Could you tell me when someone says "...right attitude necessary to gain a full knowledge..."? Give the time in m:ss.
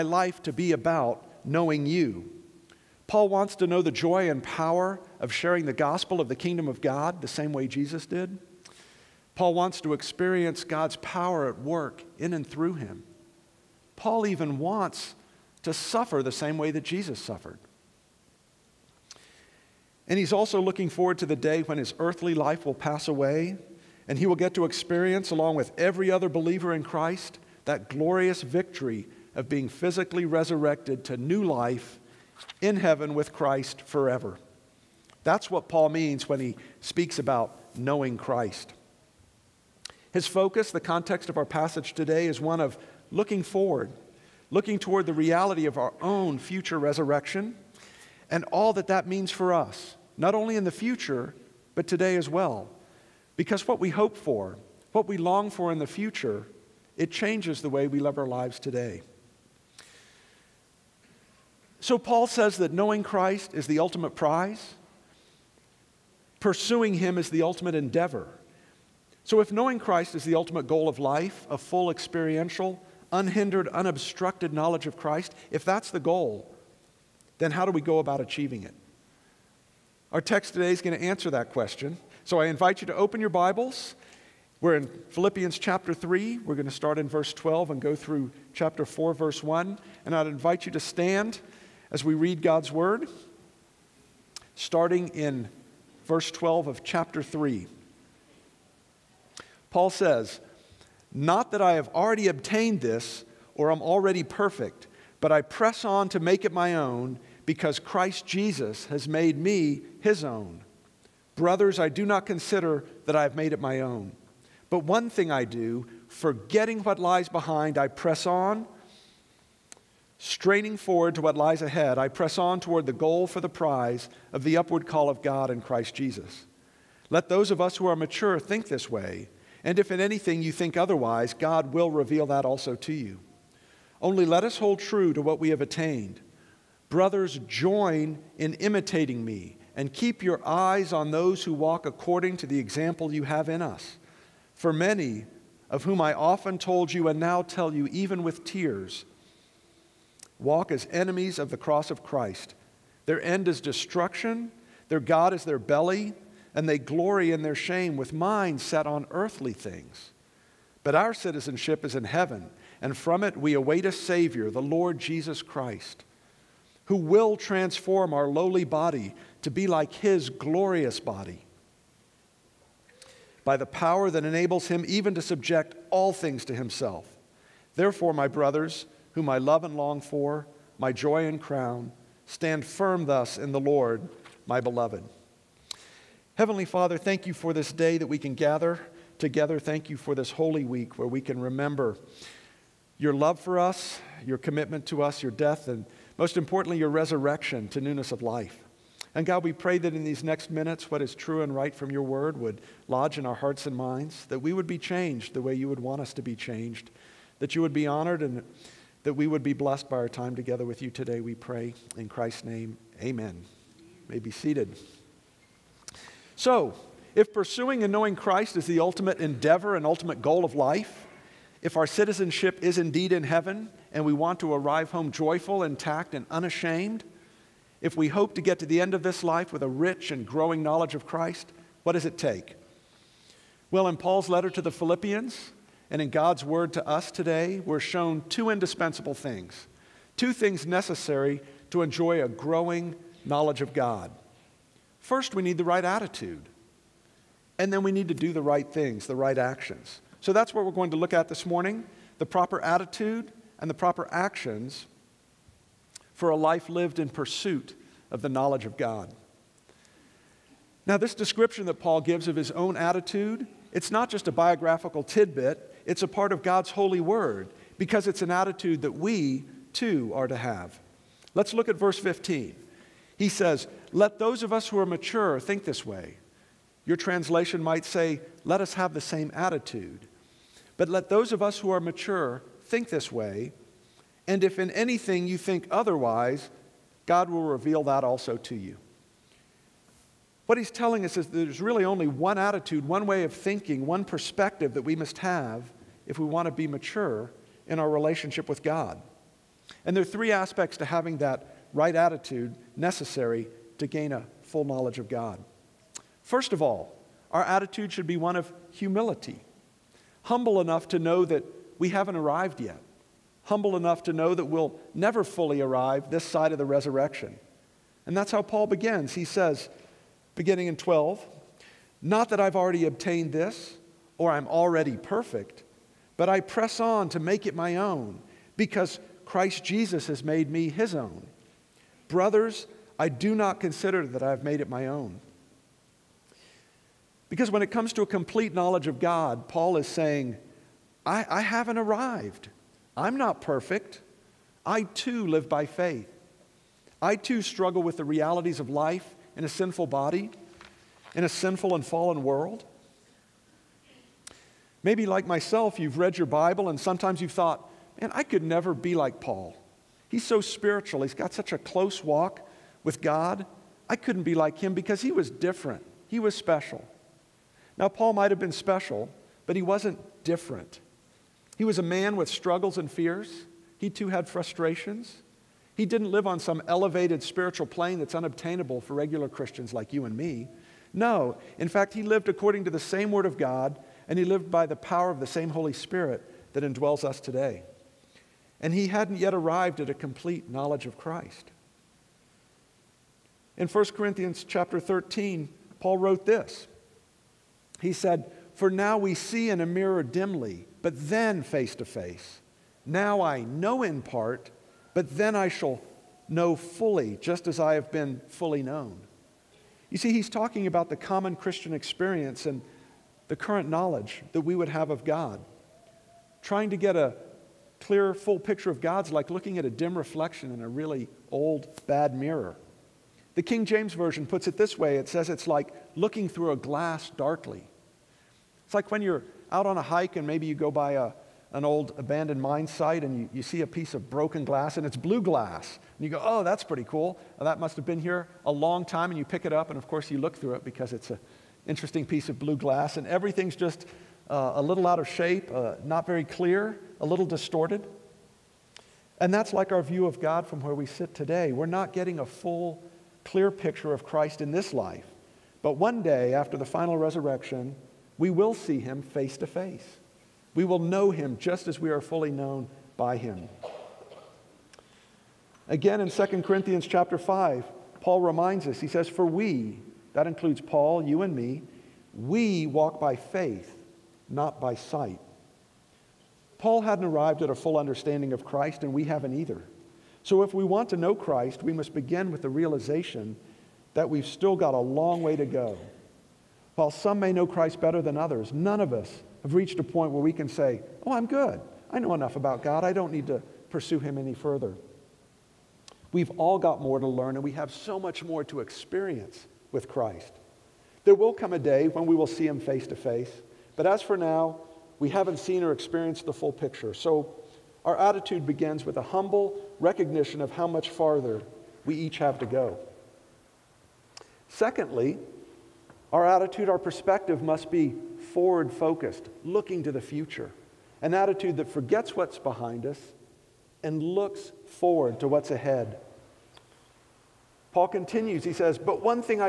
5:01.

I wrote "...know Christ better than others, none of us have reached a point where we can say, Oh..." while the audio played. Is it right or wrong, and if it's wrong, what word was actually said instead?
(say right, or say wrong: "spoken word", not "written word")
right.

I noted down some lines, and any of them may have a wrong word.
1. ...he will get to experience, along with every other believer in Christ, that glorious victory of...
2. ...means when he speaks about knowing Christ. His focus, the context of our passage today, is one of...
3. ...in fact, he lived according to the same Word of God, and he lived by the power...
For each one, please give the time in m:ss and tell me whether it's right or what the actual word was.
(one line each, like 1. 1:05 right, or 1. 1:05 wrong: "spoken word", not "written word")
1. 0:24 right
2. 0:35 right
3. 6:21 right.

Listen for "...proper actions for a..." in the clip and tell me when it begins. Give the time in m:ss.
4:13.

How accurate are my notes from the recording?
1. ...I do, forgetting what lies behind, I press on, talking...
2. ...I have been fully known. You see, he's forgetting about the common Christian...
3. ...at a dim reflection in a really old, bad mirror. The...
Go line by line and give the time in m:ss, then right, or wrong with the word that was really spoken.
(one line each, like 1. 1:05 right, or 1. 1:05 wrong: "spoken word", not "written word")
1. 1:55 wrong: "straining", not "talking"
2. 6:47 wrong: "talking", not "forgetting"
3. 6:59 right.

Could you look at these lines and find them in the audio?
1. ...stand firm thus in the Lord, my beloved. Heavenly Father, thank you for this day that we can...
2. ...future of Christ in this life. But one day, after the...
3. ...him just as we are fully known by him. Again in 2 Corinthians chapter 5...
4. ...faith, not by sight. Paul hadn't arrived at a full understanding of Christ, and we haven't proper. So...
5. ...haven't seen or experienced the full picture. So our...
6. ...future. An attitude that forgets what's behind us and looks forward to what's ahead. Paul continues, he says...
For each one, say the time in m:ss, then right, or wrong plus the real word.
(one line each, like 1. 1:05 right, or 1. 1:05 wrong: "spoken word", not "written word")
1. 3:02 right
2. 7:33 wrong: "picture", not "future"
3. 7:41 right
4. 7:53 wrong: "either", not "proper"
5. 8:25 right
6. 8:39 right.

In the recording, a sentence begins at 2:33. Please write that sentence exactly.
Their end is destruction, their God is their belly, and they glory in their shame with minds set on earthly things.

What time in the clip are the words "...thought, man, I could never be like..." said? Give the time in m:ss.
5:57.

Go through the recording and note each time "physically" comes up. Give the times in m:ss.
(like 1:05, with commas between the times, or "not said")
0:29.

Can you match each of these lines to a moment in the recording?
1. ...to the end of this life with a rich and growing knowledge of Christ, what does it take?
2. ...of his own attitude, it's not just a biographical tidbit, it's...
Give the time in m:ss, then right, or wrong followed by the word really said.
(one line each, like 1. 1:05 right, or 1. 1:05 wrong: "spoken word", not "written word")
1. 3:48 right
2. 4:22 right.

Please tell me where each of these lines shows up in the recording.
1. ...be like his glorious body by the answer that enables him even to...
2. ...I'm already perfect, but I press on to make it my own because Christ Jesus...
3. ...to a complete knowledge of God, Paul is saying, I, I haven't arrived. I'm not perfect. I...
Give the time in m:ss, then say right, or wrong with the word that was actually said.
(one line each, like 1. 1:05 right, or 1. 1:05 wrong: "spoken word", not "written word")
1. 2:49 wrong: "power", not "answer"
2. 5:24 right
3. 5:37 right.